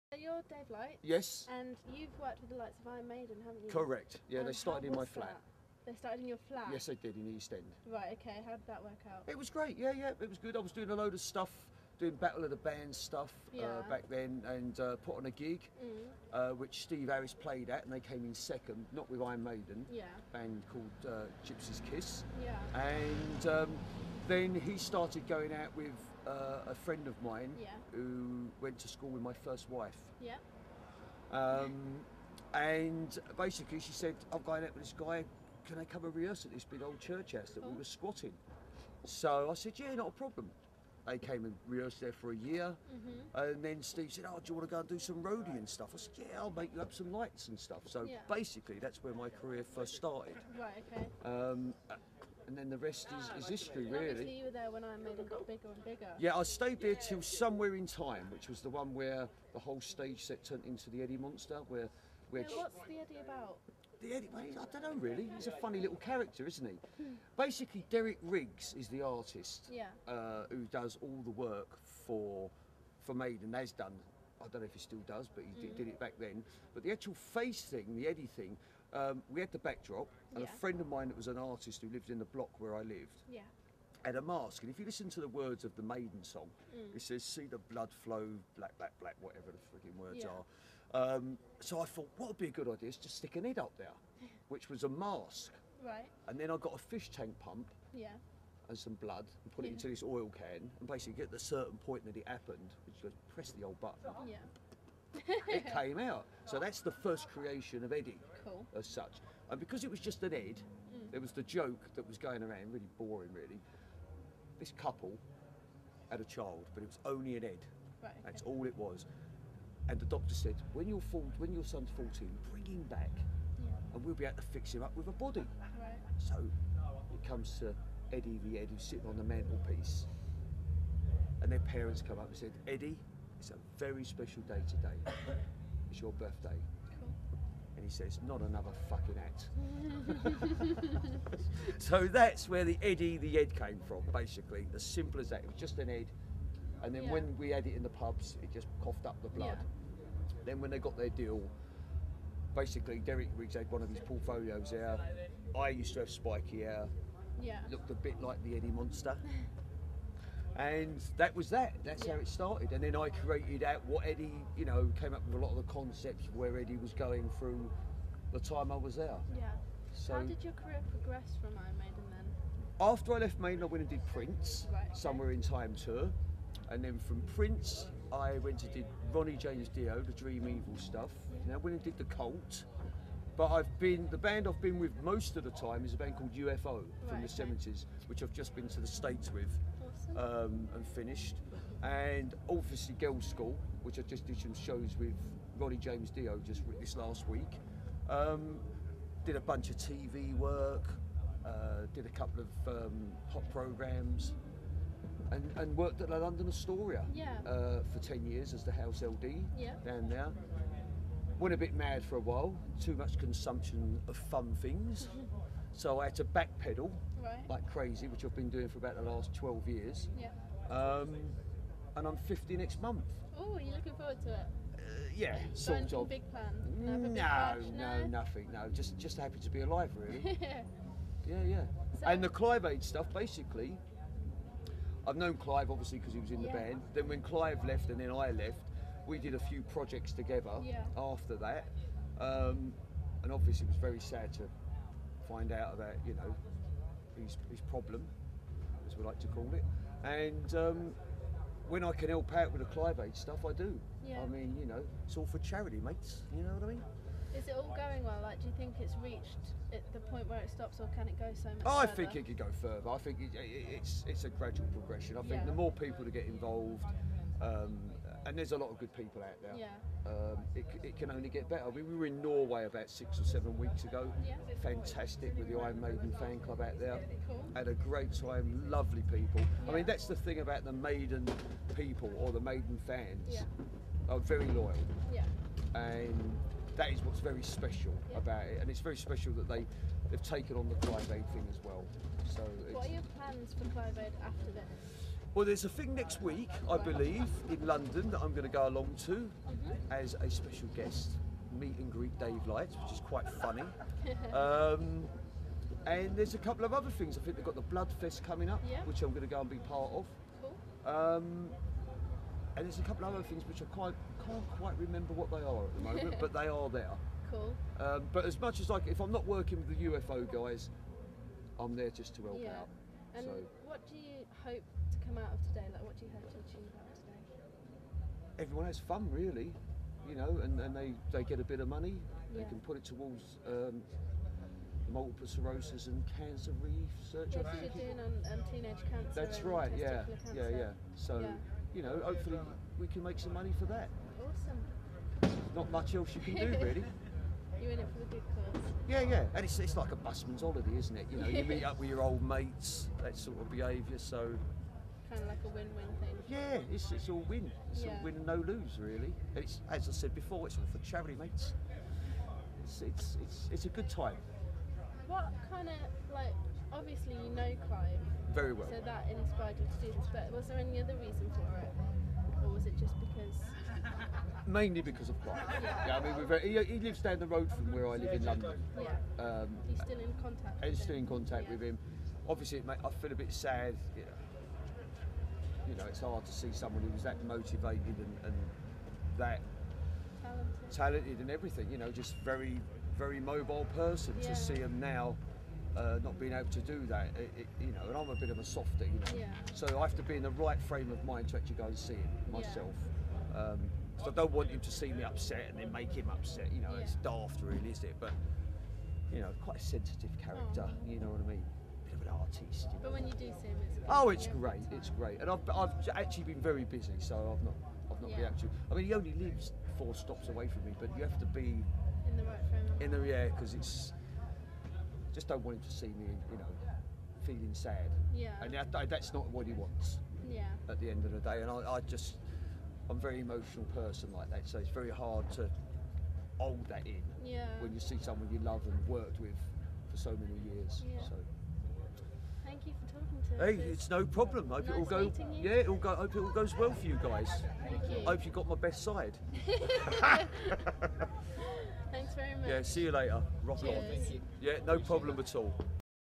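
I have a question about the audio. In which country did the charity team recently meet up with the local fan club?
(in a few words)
Norway.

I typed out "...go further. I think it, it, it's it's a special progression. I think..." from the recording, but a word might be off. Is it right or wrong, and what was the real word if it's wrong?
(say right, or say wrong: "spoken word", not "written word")
wrong: "gradual", not "special".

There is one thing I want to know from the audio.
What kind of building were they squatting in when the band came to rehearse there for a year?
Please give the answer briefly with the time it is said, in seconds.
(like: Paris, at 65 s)
Church house, at 36 s.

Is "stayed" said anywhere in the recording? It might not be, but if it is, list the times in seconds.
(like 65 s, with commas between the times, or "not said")
56 s.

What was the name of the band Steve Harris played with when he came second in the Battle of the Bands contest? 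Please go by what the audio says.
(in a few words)
Gypsy's Kiss.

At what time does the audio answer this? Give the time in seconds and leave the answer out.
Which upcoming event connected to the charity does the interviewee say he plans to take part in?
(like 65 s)
307 s.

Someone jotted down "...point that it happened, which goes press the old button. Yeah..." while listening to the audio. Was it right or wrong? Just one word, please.
right.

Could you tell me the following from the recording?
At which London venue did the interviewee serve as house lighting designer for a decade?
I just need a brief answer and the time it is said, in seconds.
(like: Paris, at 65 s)
London Astoria, at 206 s.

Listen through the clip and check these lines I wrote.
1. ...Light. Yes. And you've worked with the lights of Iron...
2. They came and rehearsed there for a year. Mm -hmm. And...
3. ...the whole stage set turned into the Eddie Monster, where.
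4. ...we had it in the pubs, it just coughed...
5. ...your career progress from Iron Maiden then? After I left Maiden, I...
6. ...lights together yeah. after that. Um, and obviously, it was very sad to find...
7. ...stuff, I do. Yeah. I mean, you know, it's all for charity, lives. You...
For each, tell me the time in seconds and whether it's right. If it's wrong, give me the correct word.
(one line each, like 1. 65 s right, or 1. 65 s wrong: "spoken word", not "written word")
1. 0 s right
2. 41 s right
3. 59 s right
4. 147 s right
5. 170 s right
6. 239 s wrong: "projects", not "lights"
7. 253 s wrong: "mates", not "lives".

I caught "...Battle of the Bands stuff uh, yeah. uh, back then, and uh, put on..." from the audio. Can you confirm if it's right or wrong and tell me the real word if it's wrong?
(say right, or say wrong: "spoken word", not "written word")
right.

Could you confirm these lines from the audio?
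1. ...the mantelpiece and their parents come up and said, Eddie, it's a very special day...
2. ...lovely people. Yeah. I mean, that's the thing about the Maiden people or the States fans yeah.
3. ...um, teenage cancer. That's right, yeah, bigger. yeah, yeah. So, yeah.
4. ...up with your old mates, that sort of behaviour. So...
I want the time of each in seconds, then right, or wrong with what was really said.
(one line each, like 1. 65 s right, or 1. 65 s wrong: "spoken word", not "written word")
1. 129 s right
2. 278 s wrong: "Maiden", not "States"
3. 338 s wrong: "cancer", not "bigger"
4. 351 s right.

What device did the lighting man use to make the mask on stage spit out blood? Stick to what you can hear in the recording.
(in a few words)
Fish tank pump.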